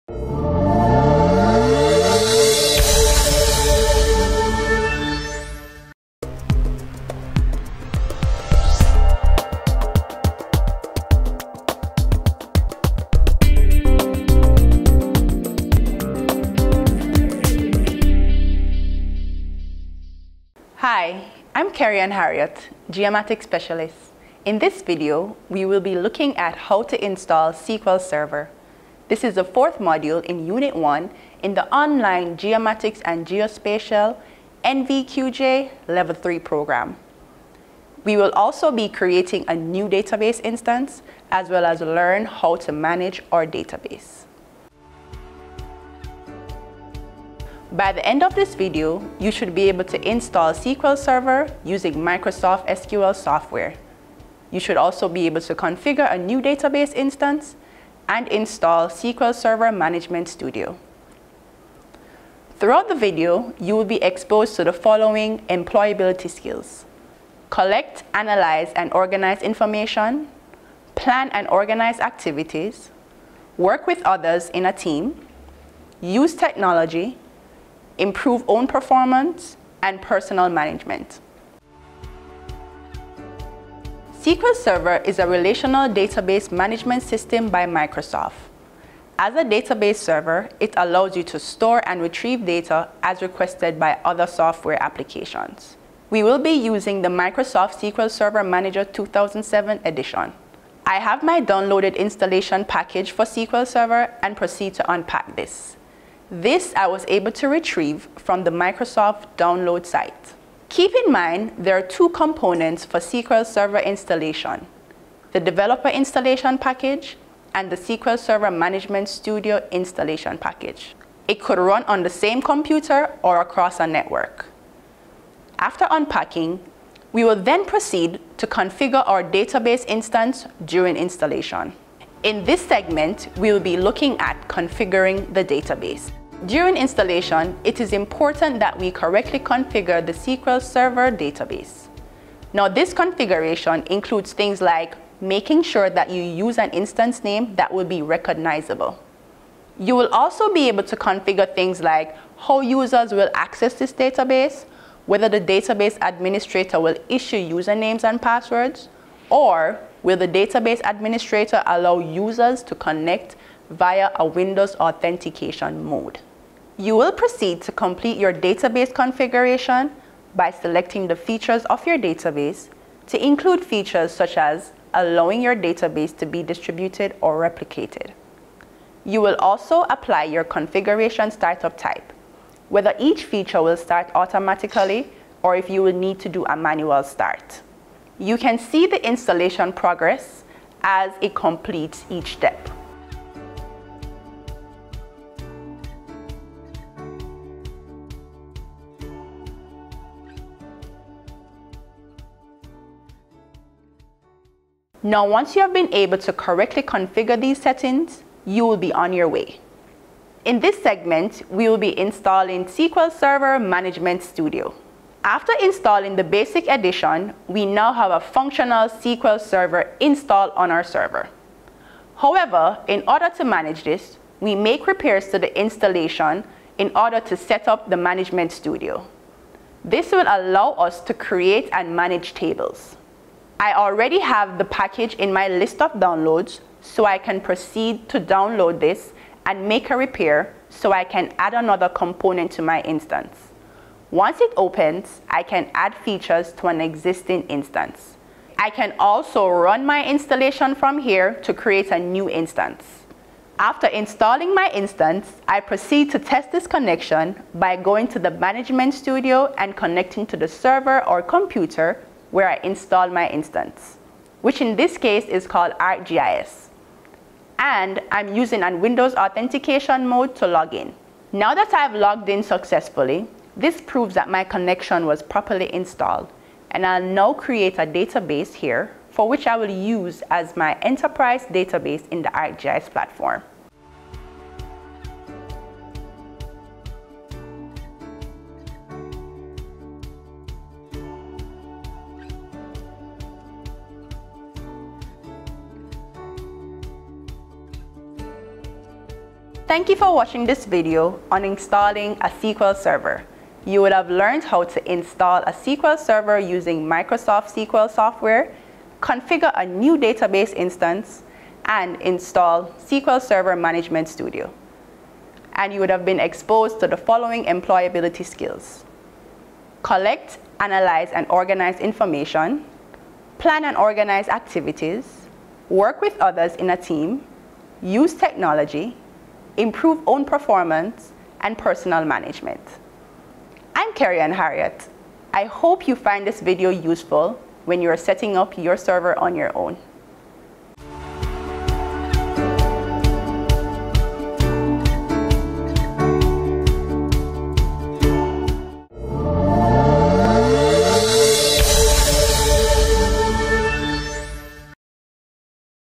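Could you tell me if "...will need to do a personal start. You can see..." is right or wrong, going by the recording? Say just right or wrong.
wrong.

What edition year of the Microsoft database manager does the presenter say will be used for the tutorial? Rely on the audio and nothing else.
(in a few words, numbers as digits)
2007.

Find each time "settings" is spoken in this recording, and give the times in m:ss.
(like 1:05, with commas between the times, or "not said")
3:27, 5:37.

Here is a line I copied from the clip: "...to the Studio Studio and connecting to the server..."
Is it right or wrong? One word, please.
wrong.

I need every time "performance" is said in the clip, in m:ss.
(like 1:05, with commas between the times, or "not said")
1:18, 5:30.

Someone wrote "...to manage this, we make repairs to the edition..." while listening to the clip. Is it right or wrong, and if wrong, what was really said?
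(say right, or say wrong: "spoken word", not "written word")
wrong: "installation", not "edition".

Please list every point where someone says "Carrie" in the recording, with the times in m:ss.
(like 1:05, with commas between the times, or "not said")
0:21, 5:33.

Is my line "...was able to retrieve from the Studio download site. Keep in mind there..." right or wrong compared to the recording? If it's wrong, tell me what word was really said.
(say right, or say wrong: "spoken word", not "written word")
wrong: "Microsoft", not "Studio".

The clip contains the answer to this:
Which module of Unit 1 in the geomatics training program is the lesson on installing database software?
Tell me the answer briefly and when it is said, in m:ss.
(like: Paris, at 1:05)
fourth, at 0:29.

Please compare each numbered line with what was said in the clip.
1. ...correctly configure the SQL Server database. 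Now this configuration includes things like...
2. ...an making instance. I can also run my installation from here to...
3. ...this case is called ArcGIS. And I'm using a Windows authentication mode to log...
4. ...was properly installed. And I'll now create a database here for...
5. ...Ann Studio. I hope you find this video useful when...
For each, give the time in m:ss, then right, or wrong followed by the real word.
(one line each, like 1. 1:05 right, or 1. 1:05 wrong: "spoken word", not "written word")
1. 2:18 right
2. 4:06 wrong: "existing", not "making"
3. 4:24 right
4. 4:35 right
5. 5:34 wrong: "Harriott", not "Studio".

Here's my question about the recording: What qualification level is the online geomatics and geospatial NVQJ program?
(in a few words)
Level 3.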